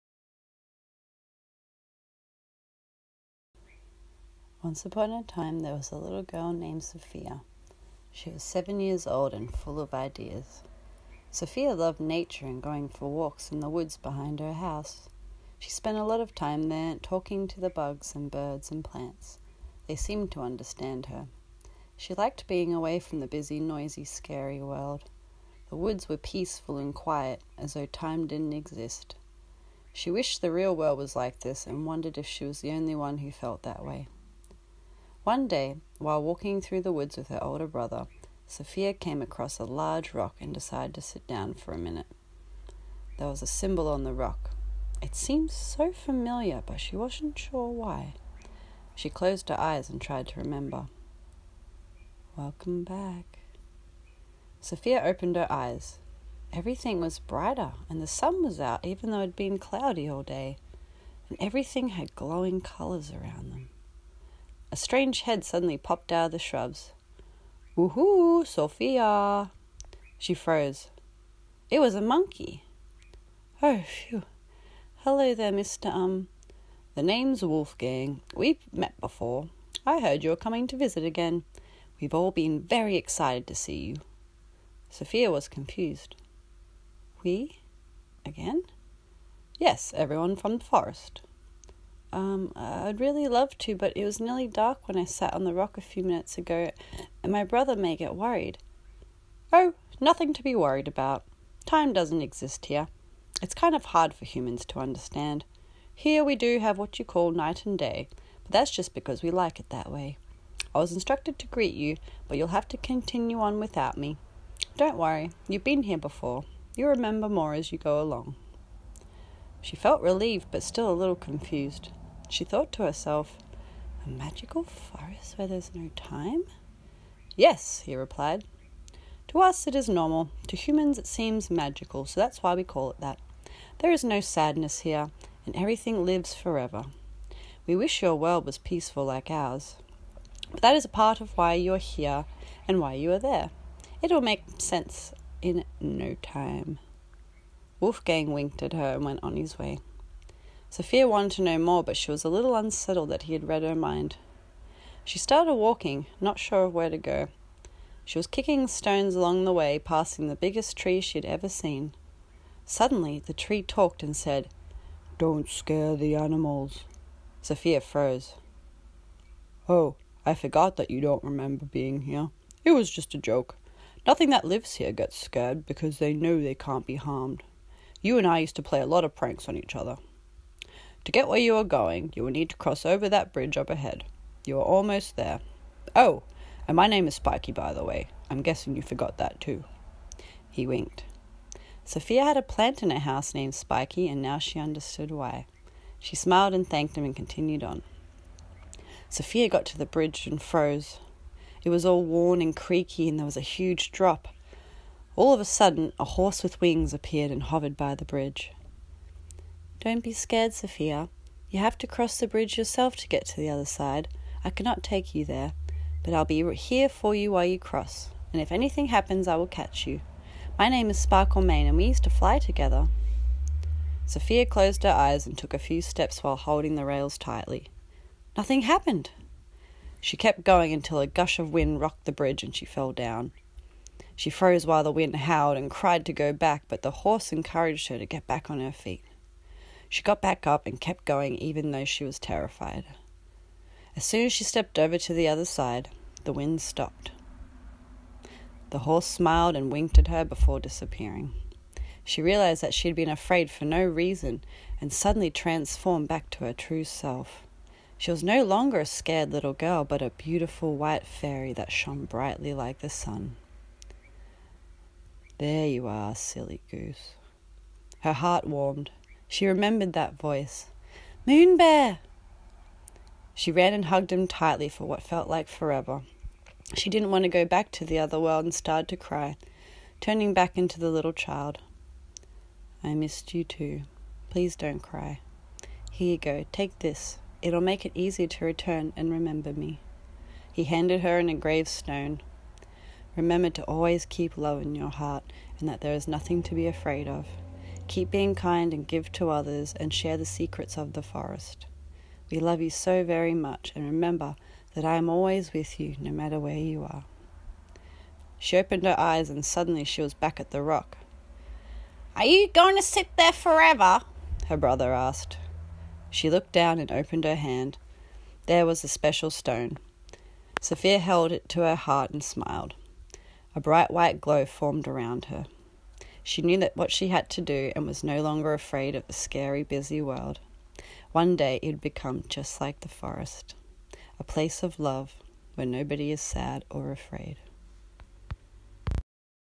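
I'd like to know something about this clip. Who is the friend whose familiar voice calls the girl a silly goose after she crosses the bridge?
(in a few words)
Moon Bear.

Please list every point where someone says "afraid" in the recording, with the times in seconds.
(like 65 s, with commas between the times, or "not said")
253 s, 296 s, 328 s, 336 s.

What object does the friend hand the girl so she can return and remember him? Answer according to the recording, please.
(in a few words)
an engraved stone.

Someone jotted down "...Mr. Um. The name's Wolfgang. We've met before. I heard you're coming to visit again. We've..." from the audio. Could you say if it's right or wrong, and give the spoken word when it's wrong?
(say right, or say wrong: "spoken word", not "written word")
right.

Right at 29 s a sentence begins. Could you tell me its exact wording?
She wished the real world was like this and wondered if she was the only one who felt that way.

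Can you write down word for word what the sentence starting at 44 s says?
It seemed so familiar, but she wasn't sure why.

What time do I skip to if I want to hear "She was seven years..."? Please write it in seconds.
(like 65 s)
8 s.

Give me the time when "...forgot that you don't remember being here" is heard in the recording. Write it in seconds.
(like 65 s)
170 s.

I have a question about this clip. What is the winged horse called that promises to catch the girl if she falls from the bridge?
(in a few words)
Sparklemane.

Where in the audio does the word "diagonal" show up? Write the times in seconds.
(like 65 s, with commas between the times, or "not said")
not said.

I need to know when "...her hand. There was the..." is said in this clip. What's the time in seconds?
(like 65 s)
317 s.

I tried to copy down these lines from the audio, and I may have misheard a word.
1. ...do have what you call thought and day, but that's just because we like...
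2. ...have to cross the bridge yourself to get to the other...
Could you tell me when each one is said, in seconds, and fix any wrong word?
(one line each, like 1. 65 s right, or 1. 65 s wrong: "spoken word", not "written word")
1. 106 s wrong: "night", not "thought"
2. 211 s right.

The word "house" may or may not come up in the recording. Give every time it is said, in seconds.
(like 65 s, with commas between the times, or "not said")
14 s, 192 s.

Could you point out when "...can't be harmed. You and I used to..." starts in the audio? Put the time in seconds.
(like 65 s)
176 s.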